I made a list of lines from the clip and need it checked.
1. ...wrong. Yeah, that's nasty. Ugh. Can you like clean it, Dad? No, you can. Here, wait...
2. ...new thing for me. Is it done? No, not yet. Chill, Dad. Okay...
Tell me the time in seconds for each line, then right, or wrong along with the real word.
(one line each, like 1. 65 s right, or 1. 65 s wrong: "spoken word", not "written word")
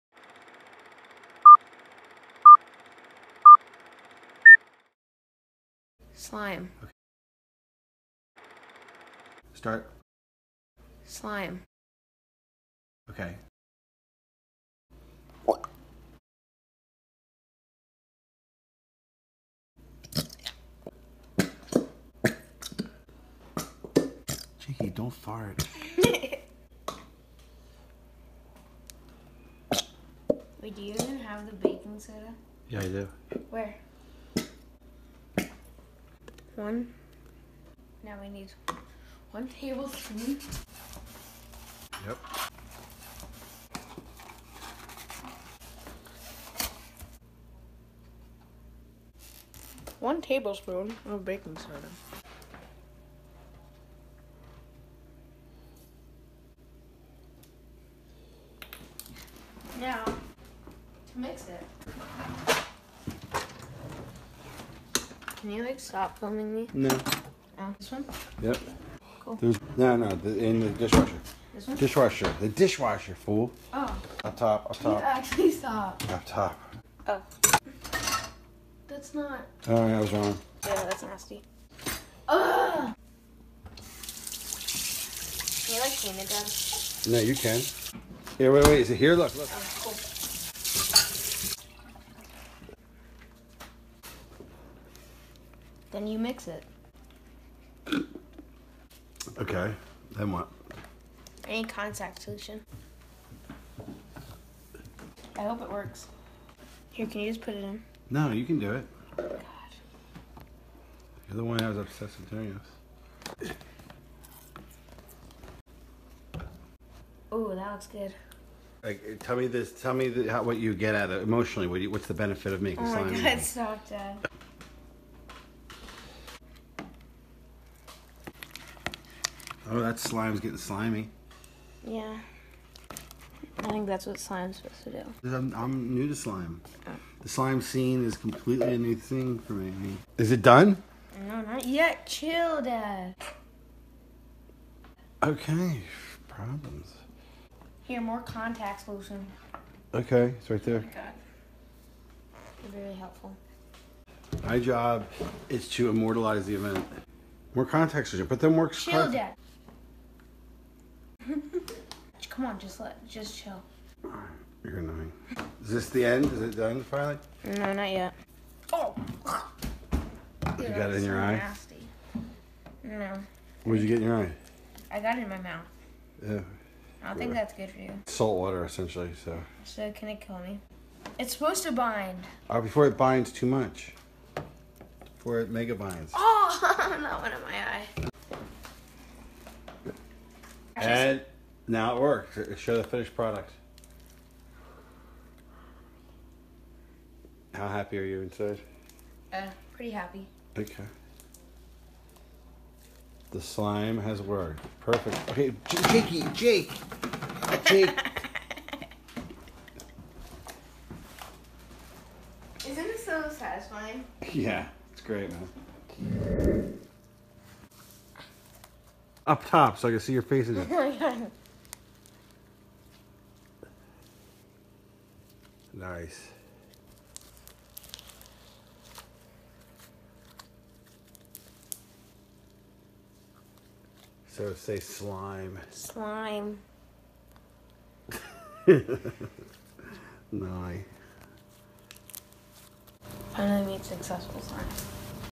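1. 80 s right
2. 138 s right.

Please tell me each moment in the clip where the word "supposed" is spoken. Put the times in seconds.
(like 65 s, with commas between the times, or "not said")
134 s, 181 s.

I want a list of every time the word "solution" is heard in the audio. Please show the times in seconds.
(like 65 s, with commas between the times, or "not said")
102 s, 148 s, 158 s.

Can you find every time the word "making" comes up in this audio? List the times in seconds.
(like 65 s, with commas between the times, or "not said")
122 s.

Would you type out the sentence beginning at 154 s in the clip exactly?
My job is to immortalize the event.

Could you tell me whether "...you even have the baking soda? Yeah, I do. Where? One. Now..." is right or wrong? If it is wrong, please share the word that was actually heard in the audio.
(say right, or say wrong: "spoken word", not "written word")
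right.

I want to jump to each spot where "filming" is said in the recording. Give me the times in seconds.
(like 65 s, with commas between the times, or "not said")
66 s.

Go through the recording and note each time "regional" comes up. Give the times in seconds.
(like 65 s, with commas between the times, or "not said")
not said.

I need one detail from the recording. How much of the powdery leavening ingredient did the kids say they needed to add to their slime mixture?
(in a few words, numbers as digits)
1 tablespoon.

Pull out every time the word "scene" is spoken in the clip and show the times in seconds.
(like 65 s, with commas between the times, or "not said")
137 s.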